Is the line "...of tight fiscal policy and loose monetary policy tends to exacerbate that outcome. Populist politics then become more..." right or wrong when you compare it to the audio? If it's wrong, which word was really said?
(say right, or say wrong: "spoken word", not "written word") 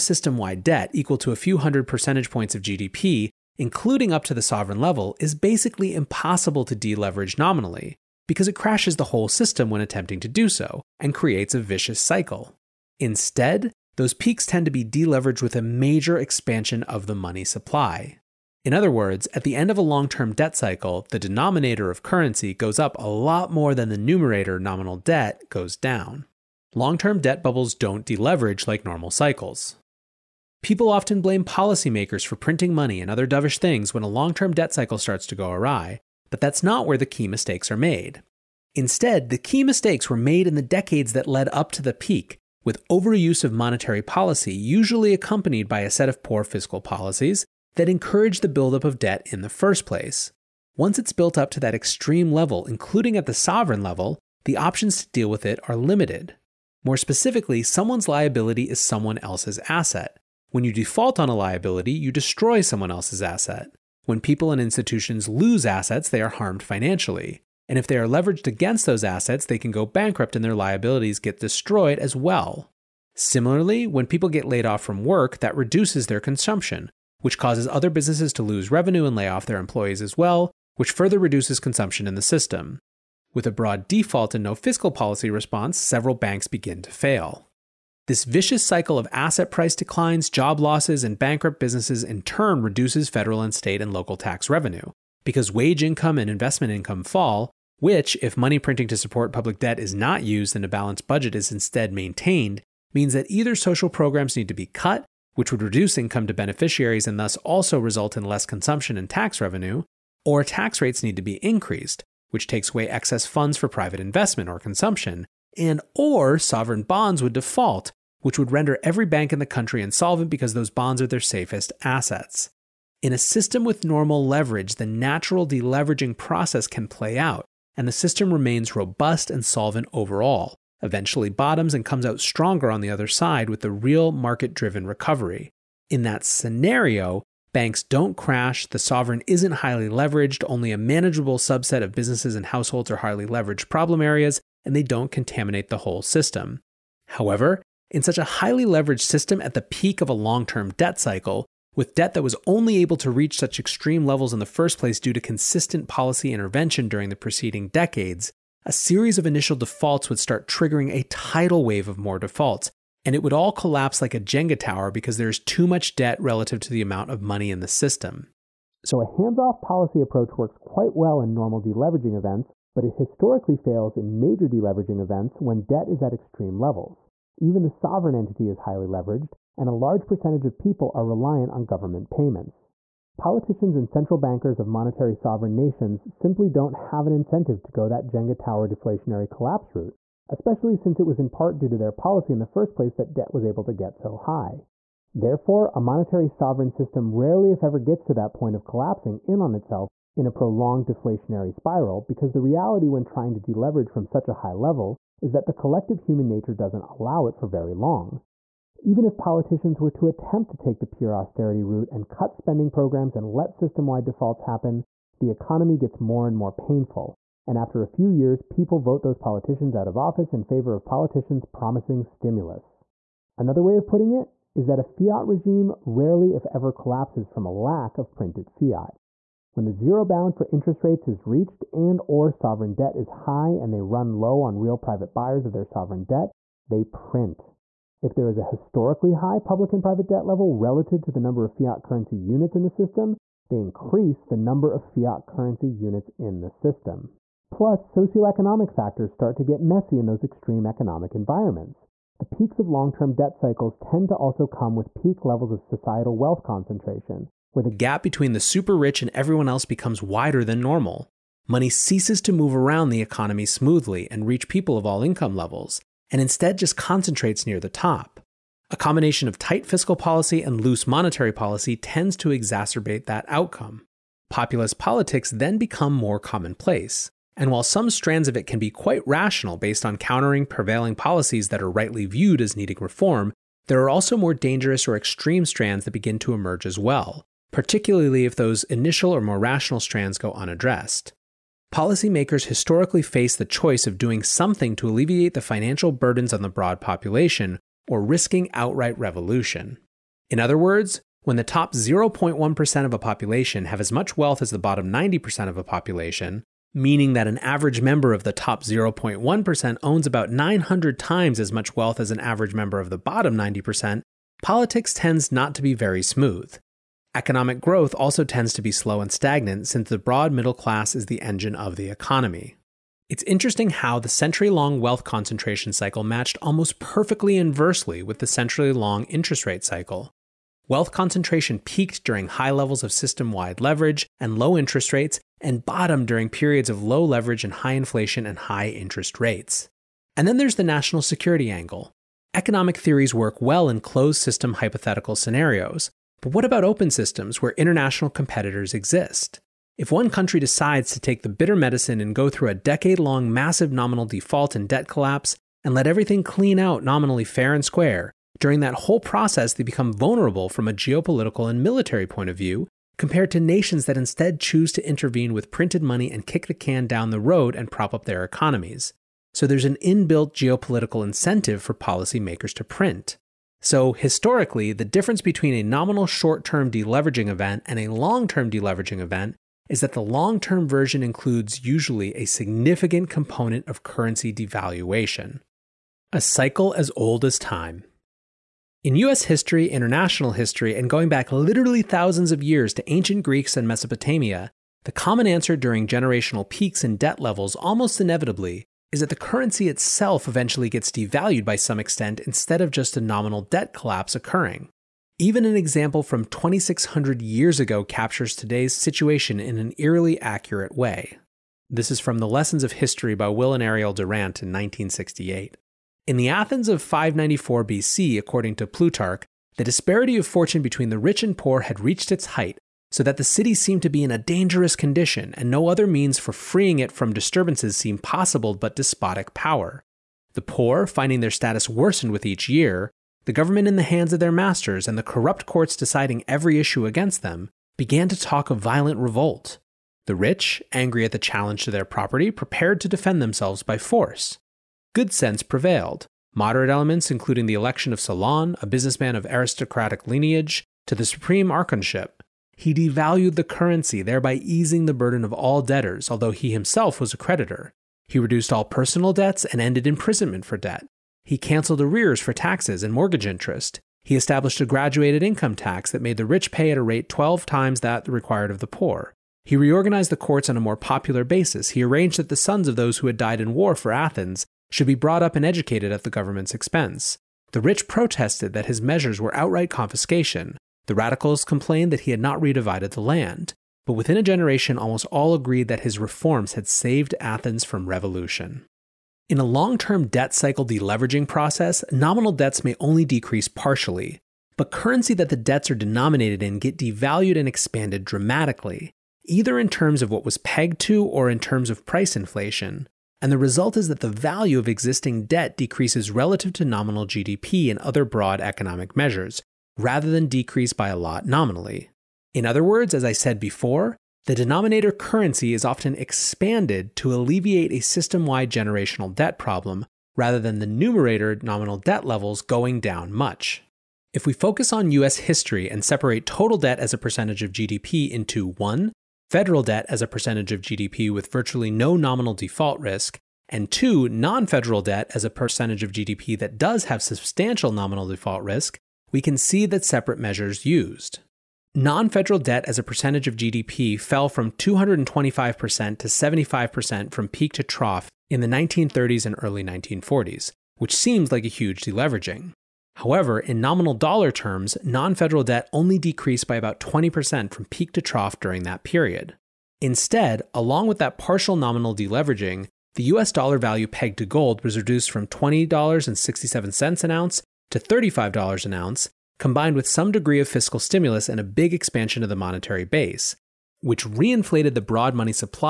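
right.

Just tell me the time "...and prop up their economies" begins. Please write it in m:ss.
6:07.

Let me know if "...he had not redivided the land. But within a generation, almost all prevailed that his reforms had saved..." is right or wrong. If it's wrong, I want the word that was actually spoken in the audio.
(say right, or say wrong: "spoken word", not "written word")
wrong: "agreed", not "prevailed".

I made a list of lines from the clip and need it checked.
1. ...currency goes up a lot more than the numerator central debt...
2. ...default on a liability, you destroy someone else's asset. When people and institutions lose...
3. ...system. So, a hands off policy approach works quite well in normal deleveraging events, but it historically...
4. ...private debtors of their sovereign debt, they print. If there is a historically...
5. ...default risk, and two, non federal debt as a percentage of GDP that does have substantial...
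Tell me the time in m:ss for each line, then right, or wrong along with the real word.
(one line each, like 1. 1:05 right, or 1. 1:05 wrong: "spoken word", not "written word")
1. 0:22 wrong: "nominal", not "central"
2. 1:00 right
3. 2:47 right
4. 3:54 wrong: "buyers", not "debtors"
5. 8:52 right.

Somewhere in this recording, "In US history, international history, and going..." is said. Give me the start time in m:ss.
6:28.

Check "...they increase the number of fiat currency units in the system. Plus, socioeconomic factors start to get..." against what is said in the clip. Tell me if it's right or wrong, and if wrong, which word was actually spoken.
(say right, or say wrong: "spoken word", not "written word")
right.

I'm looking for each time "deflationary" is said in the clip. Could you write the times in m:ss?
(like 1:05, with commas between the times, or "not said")
3:08, 3:20.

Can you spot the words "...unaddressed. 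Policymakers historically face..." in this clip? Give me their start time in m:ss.
4:50.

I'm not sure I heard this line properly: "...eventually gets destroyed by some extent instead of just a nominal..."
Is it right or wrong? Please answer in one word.
wrong.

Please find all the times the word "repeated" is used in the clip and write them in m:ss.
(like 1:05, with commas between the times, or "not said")
not said.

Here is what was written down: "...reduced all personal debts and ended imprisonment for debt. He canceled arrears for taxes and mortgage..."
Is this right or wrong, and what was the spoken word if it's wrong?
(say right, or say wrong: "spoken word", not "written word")
right.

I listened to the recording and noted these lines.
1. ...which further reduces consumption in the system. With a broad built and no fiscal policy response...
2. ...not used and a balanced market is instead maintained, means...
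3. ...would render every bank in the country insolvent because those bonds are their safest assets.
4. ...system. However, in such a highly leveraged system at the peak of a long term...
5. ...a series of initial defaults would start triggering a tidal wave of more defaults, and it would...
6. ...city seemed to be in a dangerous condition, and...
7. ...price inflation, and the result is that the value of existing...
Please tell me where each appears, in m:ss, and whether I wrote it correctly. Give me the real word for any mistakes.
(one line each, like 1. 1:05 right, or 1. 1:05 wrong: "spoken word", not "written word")
1. 1:20 wrong: "default", not "built"
2. 1:39 wrong: "budget", not "market"
3. 1:58 right
4. 2:26 right
5. 2:38 right
6. 7:03 right
7. 8:21 right.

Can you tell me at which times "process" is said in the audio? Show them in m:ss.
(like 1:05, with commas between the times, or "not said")
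2:06, 5:58, 8:11.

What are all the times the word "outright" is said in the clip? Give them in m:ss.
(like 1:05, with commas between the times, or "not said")
4:58, 7:59.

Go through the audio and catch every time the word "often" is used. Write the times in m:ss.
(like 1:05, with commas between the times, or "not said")
0:30, 8:35.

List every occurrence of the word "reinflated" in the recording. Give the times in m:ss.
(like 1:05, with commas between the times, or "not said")
9:34.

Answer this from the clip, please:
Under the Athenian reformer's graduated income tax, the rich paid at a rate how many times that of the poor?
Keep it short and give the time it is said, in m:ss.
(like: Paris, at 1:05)
12 times, at 7:47.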